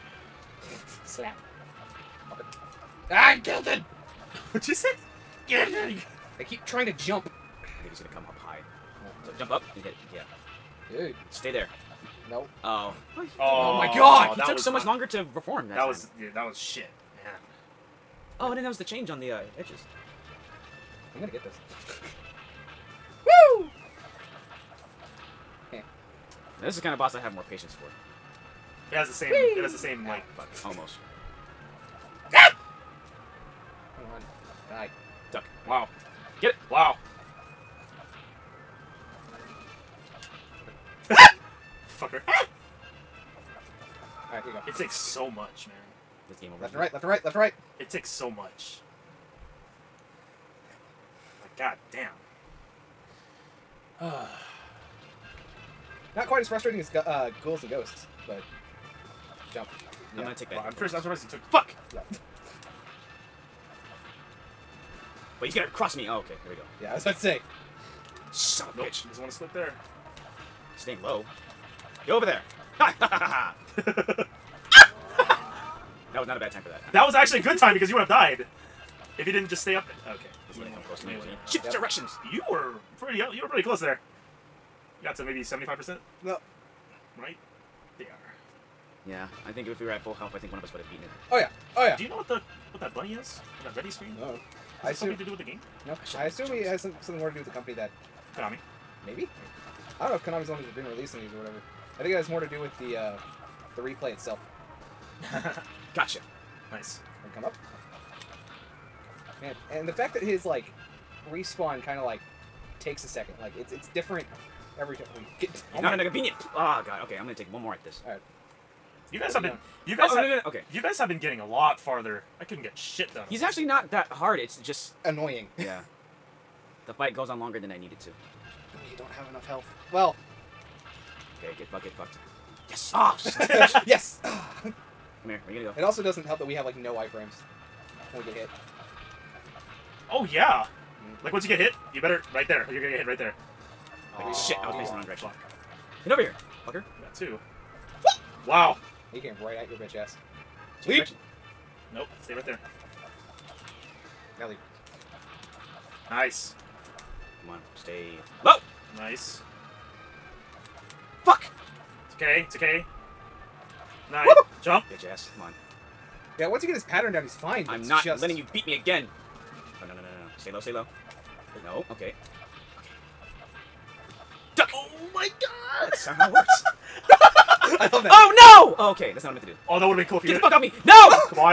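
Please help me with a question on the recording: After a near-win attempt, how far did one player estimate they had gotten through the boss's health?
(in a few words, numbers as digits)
75 percent.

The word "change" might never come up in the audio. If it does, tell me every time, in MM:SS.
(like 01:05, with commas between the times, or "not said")
00:18.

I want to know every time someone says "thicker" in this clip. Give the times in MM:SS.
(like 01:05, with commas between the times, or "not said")
not said.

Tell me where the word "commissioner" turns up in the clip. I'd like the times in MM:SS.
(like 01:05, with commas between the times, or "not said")
not said.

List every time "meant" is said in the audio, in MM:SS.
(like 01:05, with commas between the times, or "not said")
02:59.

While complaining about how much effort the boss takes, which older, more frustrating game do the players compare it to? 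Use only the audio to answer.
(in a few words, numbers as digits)
Ghouls and Ghosts.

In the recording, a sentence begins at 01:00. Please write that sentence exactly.
Well, I'm, I'm surprised he took.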